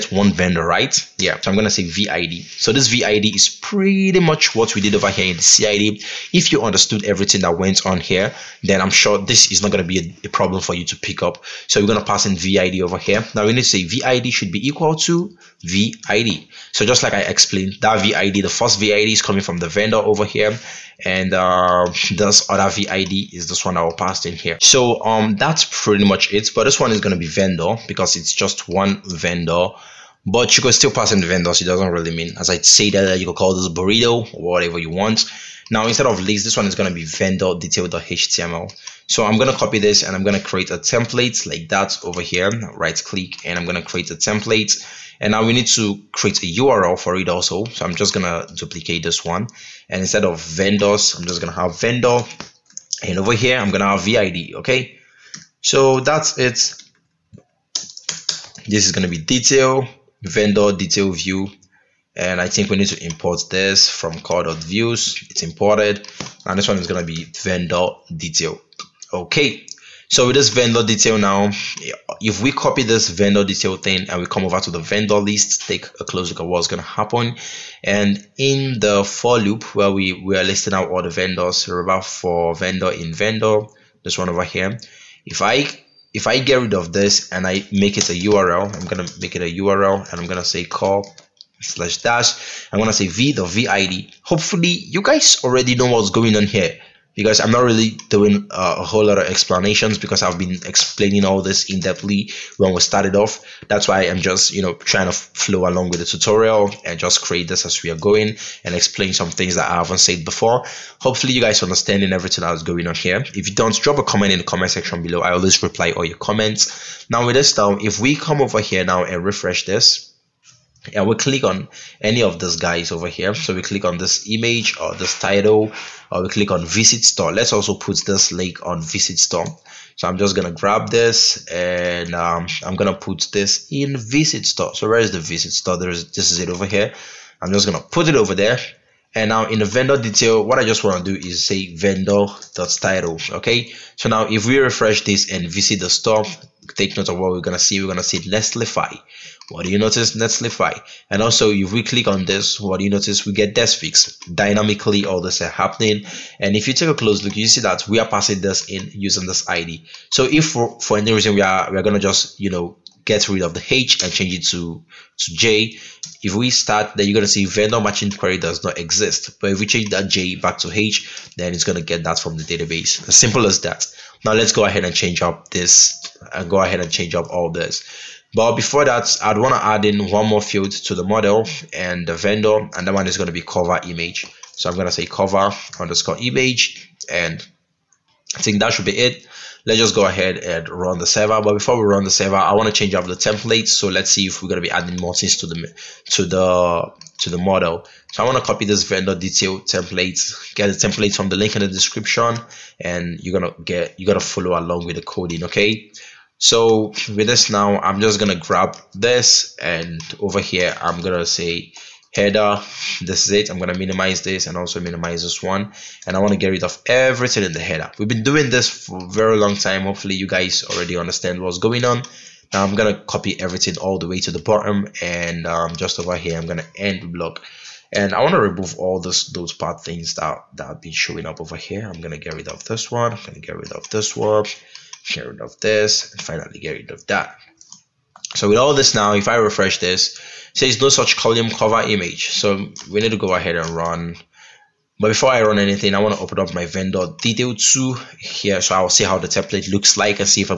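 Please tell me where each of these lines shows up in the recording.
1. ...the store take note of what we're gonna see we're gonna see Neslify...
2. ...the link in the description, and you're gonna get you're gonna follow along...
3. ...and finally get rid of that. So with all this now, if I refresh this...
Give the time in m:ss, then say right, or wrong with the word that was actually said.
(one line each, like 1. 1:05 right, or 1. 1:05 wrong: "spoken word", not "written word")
1. 2:25 right
2. 3:21 right
3. 3:56 right.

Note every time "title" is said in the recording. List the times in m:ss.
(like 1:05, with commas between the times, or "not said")
2:05, 2:22.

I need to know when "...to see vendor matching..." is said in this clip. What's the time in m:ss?
2:47.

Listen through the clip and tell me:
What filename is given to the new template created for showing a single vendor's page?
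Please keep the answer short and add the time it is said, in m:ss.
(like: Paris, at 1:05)
vendor detail.html, at 0:37.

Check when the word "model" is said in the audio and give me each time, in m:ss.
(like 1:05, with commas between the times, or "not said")
3:01, 3:17.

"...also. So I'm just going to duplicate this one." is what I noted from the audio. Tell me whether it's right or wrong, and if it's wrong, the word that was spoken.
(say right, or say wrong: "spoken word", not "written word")
right.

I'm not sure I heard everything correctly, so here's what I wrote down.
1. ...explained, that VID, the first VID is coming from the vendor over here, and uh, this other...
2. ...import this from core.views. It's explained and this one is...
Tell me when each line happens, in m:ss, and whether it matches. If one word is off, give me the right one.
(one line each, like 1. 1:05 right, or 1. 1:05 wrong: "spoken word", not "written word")
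1. 0:17 right
2. 1:03 wrong: "imported", not "explained".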